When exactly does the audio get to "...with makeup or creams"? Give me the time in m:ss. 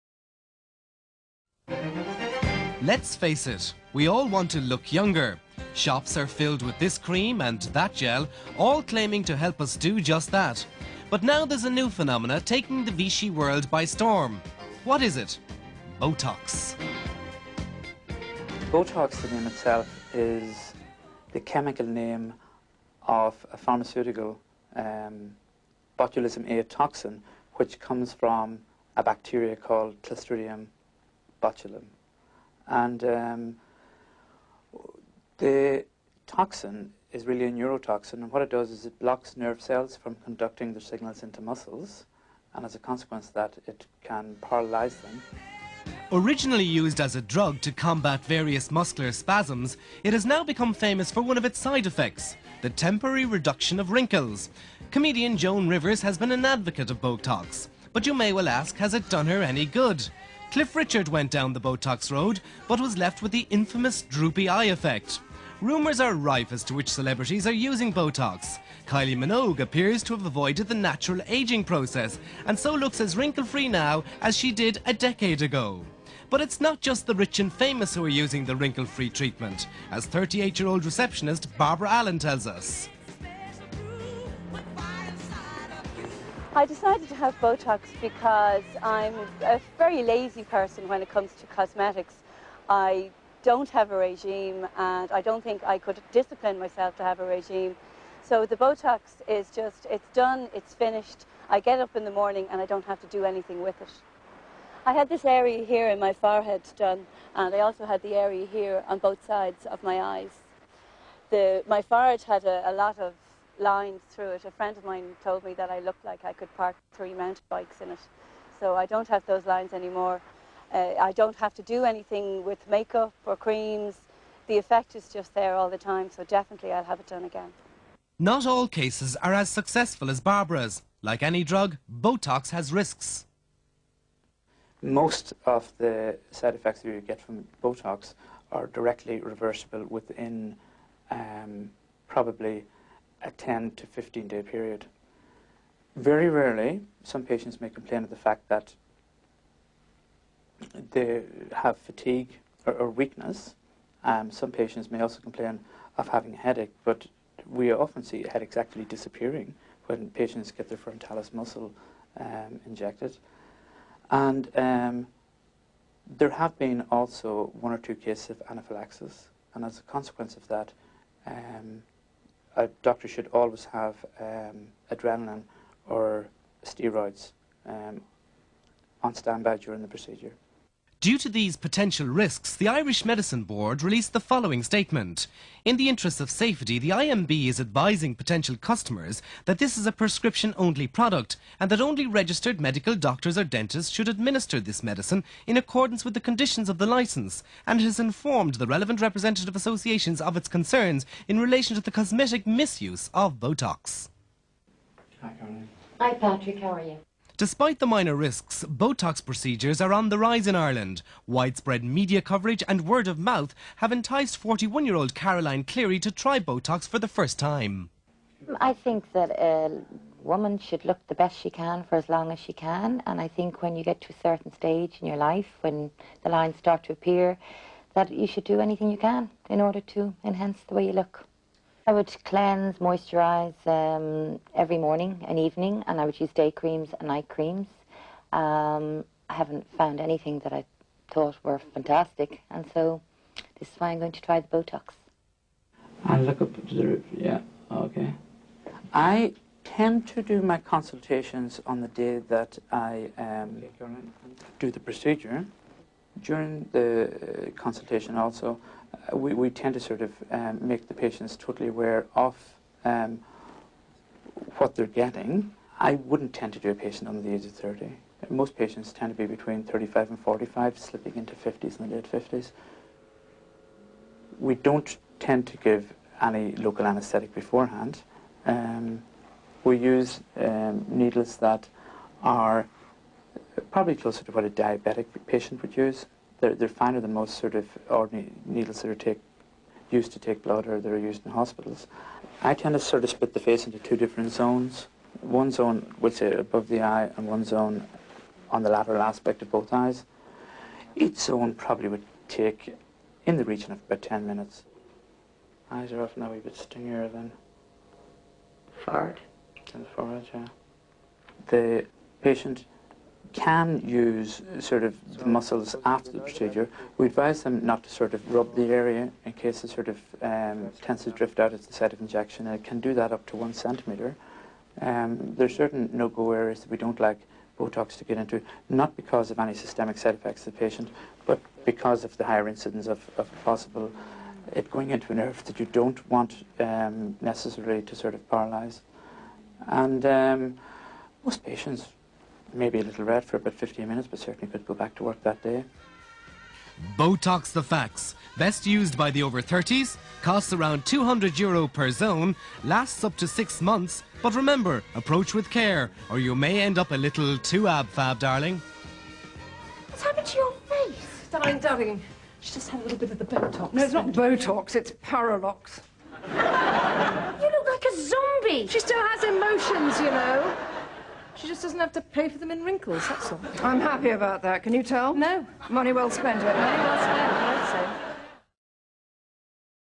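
2:02.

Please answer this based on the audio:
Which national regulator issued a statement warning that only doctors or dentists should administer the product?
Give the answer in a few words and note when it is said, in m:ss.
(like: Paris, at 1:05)
Irish Medicine Board, at 3:02.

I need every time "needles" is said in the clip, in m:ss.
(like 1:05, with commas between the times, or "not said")
4:40, 4:48.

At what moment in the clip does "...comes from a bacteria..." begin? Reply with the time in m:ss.
0:27.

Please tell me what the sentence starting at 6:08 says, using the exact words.
She still has emotions, you know.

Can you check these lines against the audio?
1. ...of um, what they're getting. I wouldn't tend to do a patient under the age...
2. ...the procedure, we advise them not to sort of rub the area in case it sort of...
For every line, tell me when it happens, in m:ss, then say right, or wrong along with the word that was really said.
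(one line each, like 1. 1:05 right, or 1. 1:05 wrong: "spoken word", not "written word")
1. 4:22 right
2. 5:16 right.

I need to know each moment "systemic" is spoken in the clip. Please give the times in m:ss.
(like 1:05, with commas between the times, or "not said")
5:29.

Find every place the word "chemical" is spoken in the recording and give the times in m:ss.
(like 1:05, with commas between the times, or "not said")
0:21.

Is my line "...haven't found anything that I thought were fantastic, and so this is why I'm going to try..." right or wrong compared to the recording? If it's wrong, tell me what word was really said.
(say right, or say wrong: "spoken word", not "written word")
right.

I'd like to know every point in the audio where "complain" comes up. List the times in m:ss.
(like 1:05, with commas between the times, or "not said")
2:27, 2:35.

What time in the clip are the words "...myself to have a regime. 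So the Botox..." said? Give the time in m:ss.
1:36.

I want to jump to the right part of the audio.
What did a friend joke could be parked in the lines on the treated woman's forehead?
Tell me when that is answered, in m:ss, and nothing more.
1:56.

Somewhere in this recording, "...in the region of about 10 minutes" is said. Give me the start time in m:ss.
5:03.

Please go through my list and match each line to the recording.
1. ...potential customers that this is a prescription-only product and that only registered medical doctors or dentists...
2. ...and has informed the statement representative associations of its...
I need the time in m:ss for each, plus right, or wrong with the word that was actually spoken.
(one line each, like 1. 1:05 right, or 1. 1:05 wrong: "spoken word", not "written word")
1. 3:08 right
2. 3:17 wrong: "relevant", not "statement".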